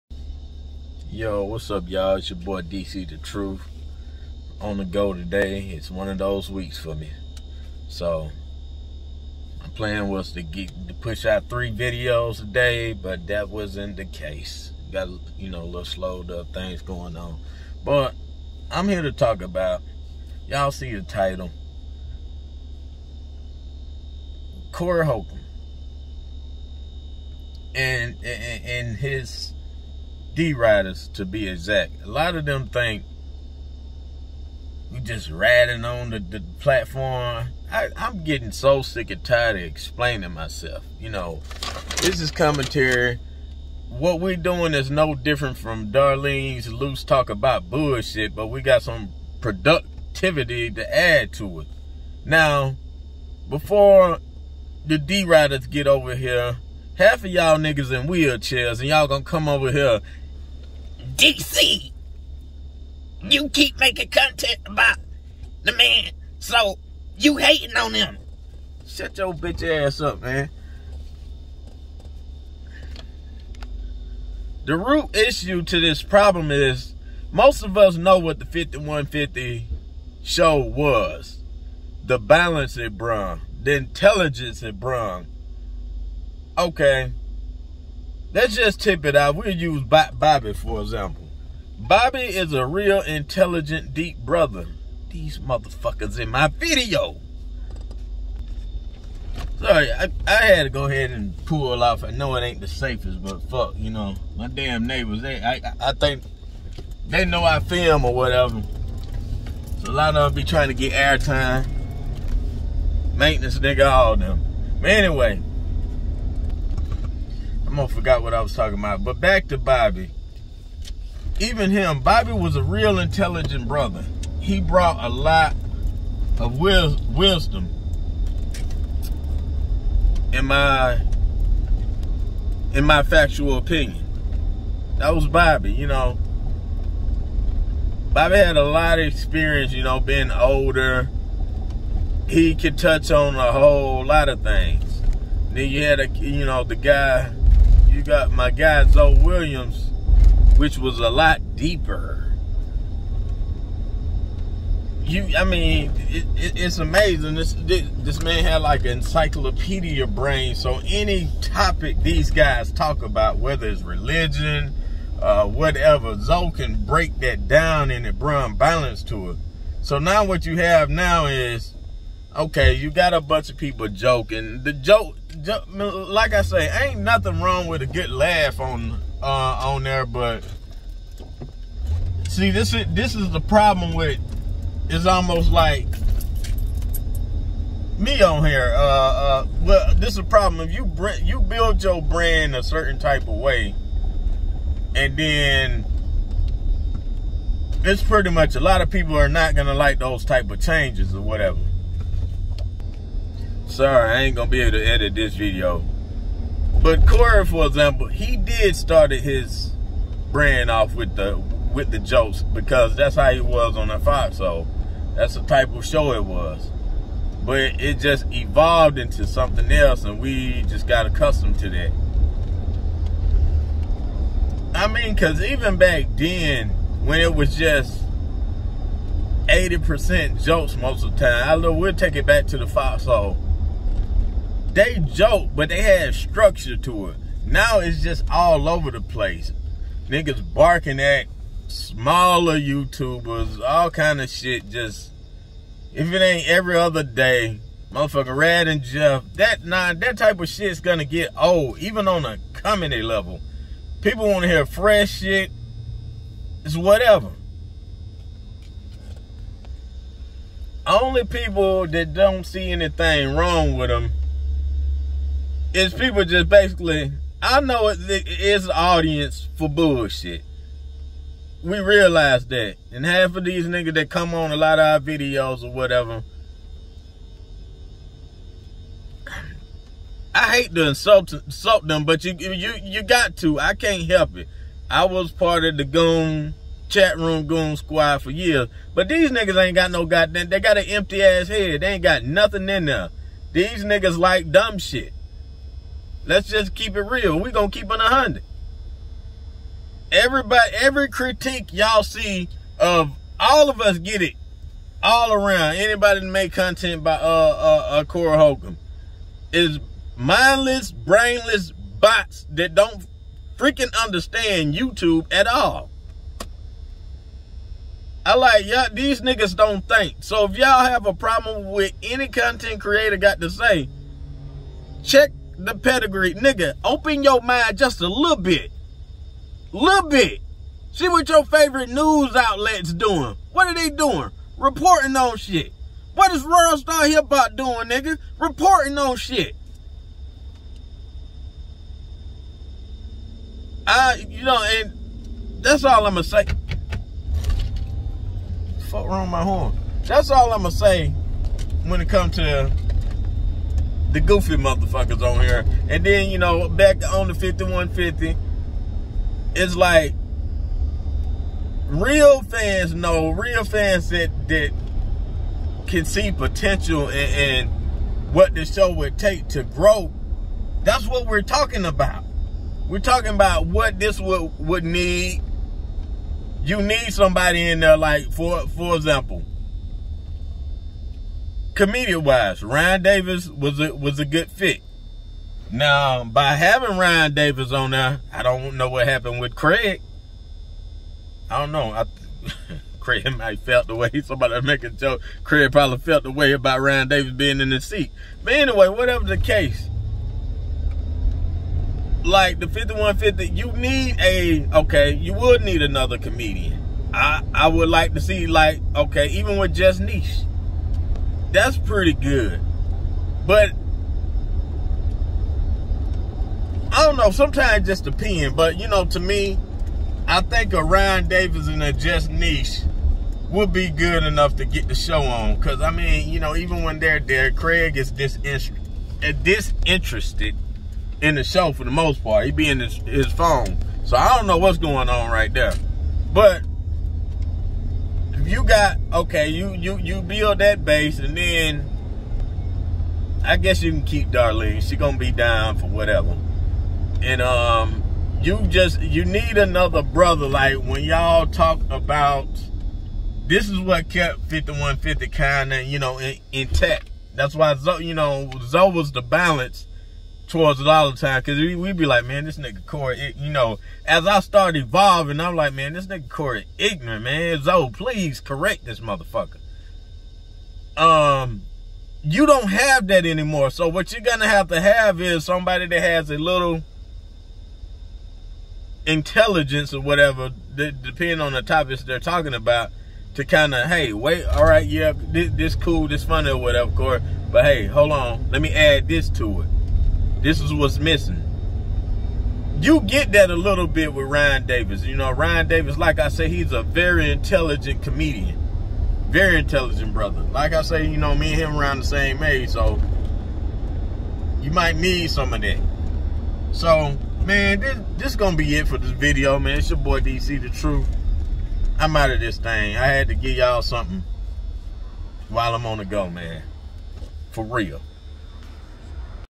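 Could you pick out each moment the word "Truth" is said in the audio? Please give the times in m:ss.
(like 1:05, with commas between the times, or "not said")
0:03, 8:30.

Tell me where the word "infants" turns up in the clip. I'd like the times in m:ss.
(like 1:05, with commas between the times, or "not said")
not said.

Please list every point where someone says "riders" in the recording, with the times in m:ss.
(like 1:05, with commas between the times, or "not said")
0:30, 0:55.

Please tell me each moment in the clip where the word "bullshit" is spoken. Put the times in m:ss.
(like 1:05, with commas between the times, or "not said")
0:47, 4:29.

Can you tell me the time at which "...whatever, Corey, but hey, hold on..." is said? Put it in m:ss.
8:06.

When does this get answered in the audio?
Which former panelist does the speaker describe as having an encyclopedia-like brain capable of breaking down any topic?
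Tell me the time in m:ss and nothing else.
2:28.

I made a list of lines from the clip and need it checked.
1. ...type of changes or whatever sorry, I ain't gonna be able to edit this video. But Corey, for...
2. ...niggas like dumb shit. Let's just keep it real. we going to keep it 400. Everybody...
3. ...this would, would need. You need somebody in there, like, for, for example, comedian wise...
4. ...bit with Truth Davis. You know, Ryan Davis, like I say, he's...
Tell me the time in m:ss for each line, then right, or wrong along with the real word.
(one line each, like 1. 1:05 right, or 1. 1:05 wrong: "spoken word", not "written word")
1. 3:20 right
2. 4:53 wrong: "100", not "400"
3. 6:13 right
4. 8:13 wrong: "Ryan", not "Truth".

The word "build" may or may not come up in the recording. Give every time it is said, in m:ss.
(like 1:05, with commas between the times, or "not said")
3:11, 7:20.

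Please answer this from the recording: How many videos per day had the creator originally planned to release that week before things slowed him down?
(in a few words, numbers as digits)
3.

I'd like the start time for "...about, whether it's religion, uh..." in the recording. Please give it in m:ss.
2:43.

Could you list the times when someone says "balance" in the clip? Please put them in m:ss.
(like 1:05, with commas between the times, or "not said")
1:22, 2:48, 7:39.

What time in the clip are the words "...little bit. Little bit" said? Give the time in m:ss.
5:28.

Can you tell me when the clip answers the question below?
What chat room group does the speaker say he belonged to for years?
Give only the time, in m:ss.
4:47.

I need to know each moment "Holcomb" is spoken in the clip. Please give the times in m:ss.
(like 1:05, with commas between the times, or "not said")
0:25, 5:08.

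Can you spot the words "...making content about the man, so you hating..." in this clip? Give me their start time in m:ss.
1:03.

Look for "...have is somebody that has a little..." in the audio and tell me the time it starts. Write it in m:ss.
7:54.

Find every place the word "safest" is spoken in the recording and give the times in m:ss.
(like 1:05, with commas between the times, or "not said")
1:42.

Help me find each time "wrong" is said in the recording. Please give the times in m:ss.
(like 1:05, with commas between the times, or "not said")
2:57, 4:23, 5:49.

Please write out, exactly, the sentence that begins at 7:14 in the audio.
So I don't know what's going on right there.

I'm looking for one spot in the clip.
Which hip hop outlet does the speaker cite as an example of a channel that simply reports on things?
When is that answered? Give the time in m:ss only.
5:36.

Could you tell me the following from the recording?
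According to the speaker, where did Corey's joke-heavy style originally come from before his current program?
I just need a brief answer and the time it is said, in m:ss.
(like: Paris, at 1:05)
the Fox, at 3:33.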